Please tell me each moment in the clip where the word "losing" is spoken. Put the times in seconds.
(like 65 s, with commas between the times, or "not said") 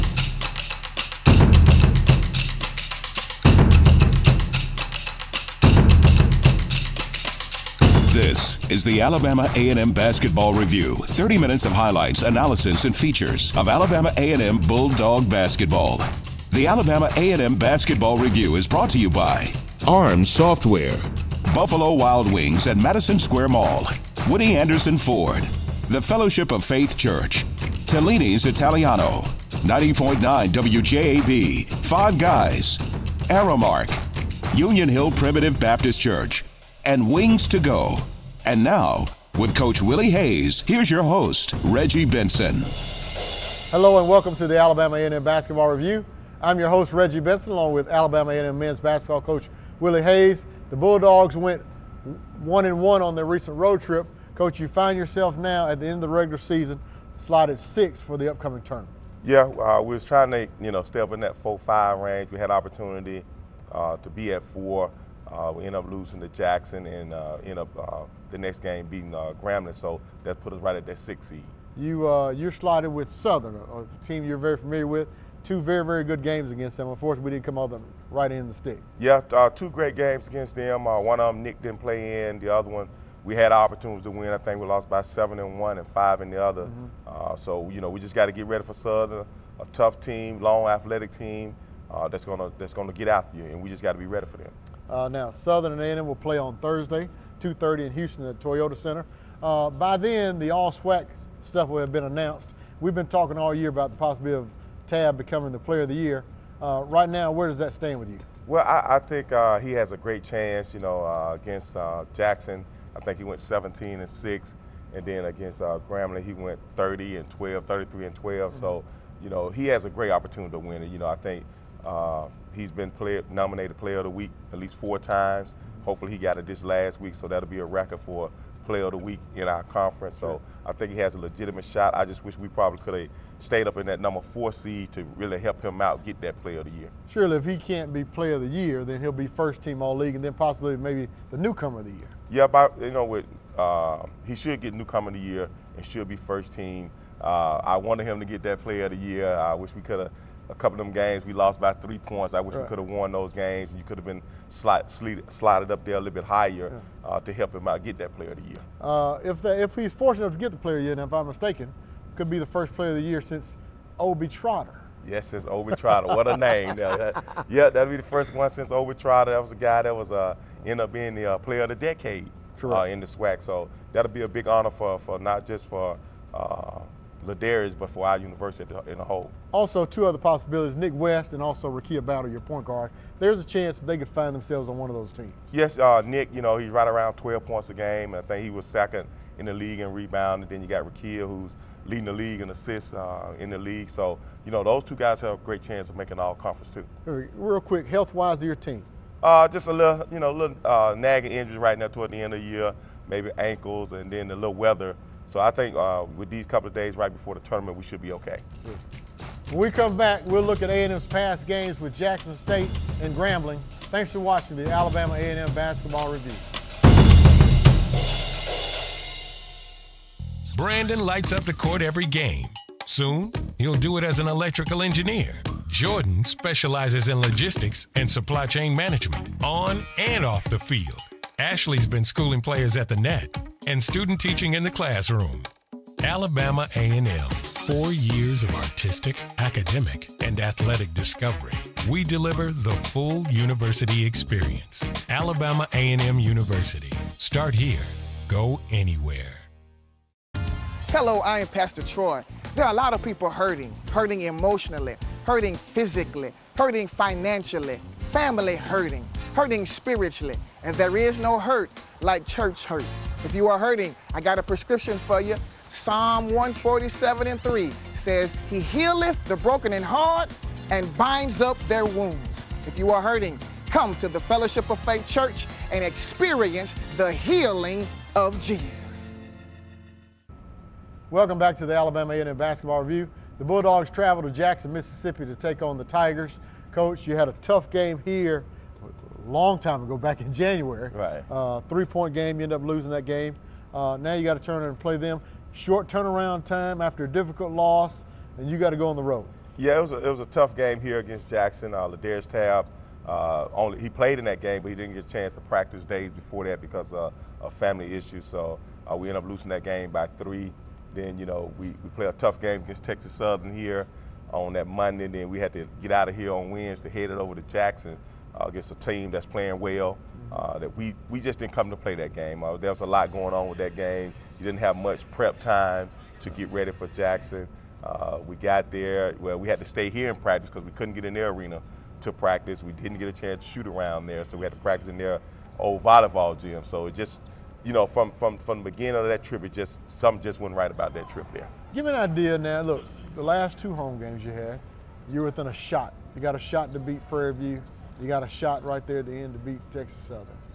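65 s, 292 s, 309 s.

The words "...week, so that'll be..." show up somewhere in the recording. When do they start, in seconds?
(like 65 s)
127 s.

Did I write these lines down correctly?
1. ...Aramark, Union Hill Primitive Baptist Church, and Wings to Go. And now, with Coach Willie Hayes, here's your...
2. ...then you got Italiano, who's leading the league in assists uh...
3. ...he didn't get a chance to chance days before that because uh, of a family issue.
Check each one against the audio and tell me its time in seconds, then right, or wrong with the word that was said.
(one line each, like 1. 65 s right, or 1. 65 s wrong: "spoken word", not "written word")
1. 33 s right
2. 190 s wrong: "Rakia", not "Italiano"
3. 304 s wrong: "practice", not "chance".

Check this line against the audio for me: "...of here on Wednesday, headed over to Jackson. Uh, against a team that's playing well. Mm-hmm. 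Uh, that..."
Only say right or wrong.
right.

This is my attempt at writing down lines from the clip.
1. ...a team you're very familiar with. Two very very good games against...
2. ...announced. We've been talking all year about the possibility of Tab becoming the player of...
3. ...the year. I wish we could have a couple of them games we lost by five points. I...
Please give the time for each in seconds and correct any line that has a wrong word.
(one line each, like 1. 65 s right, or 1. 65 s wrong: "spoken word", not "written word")
1. 73 s right
2. 102 s right
3. 148 s wrong: "three", not "five".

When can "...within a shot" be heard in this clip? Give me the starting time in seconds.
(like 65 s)
345 s.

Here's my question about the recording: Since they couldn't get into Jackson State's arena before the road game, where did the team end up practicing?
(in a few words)
old volleyball gym.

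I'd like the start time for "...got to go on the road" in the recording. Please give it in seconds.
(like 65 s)
298 s.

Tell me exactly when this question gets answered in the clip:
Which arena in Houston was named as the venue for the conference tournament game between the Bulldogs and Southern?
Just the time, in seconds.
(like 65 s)
98 s.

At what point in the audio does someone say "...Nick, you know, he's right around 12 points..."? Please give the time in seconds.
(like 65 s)
186 s.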